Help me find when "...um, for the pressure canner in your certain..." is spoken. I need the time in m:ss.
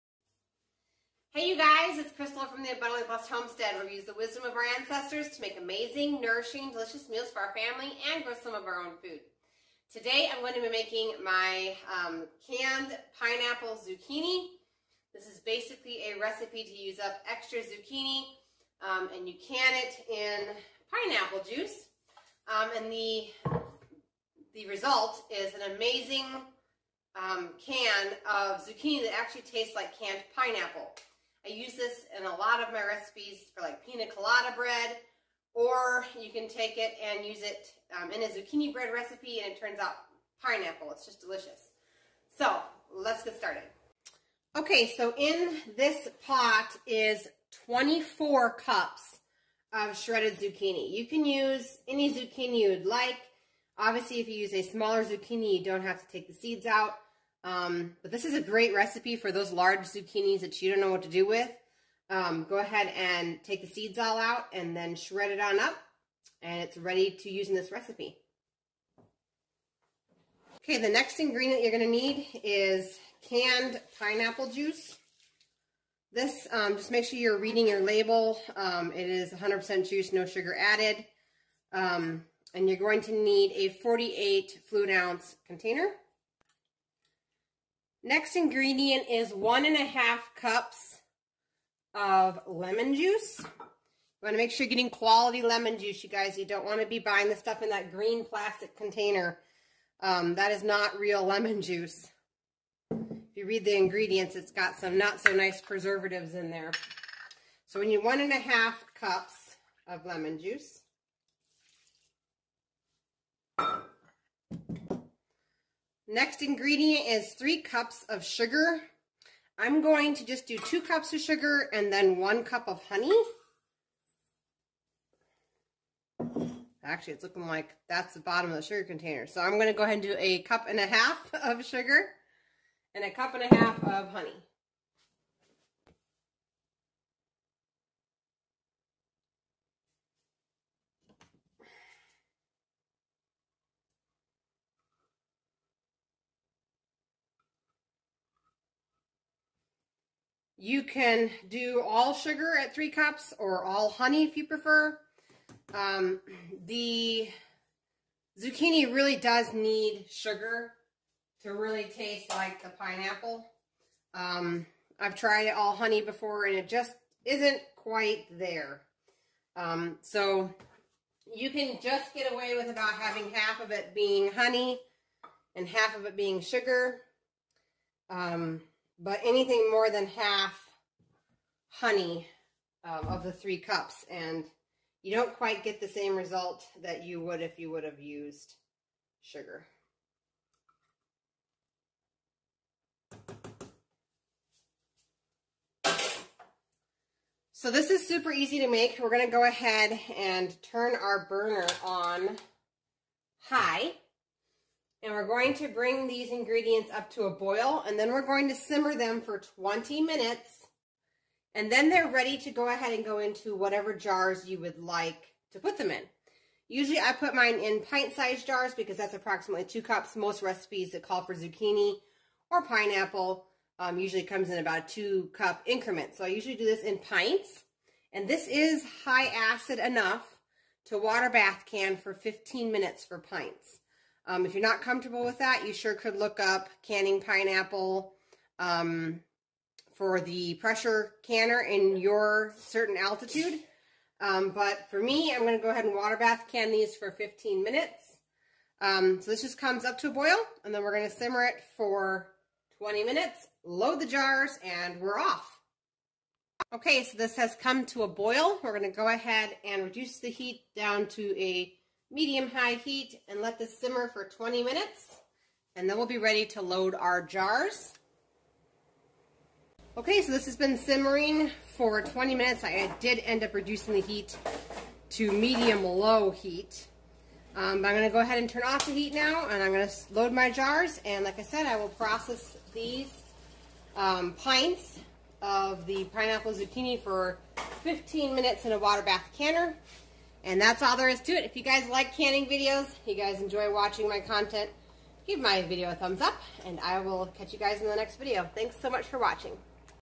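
3:58.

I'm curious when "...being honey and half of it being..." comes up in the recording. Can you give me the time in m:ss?
2:53.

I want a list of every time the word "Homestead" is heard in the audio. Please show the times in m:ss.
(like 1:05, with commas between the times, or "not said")
0:03.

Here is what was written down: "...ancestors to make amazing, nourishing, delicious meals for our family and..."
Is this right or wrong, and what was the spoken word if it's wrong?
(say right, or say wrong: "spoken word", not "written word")
right.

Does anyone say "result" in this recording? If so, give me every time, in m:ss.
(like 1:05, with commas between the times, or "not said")
0:24, 3:06.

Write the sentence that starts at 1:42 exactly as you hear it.
If you read the ingredients, it's got some not so nice preservatives in there.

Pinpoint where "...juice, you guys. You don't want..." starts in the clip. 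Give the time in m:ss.
1:35.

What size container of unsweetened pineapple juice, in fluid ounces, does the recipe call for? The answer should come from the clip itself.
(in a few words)
48 fluid ounces.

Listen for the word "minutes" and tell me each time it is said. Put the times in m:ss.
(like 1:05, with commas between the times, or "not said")
3:30, 3:52, 4:07, 4:13, 4:24, 4:32, 4:48.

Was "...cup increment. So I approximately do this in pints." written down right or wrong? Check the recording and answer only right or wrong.
wrong.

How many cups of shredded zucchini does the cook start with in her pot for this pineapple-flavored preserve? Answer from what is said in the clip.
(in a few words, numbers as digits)
24 cups.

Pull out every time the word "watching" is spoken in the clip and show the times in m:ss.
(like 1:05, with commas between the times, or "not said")
4:53, 4:59.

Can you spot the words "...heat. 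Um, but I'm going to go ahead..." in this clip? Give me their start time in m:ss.
4:36.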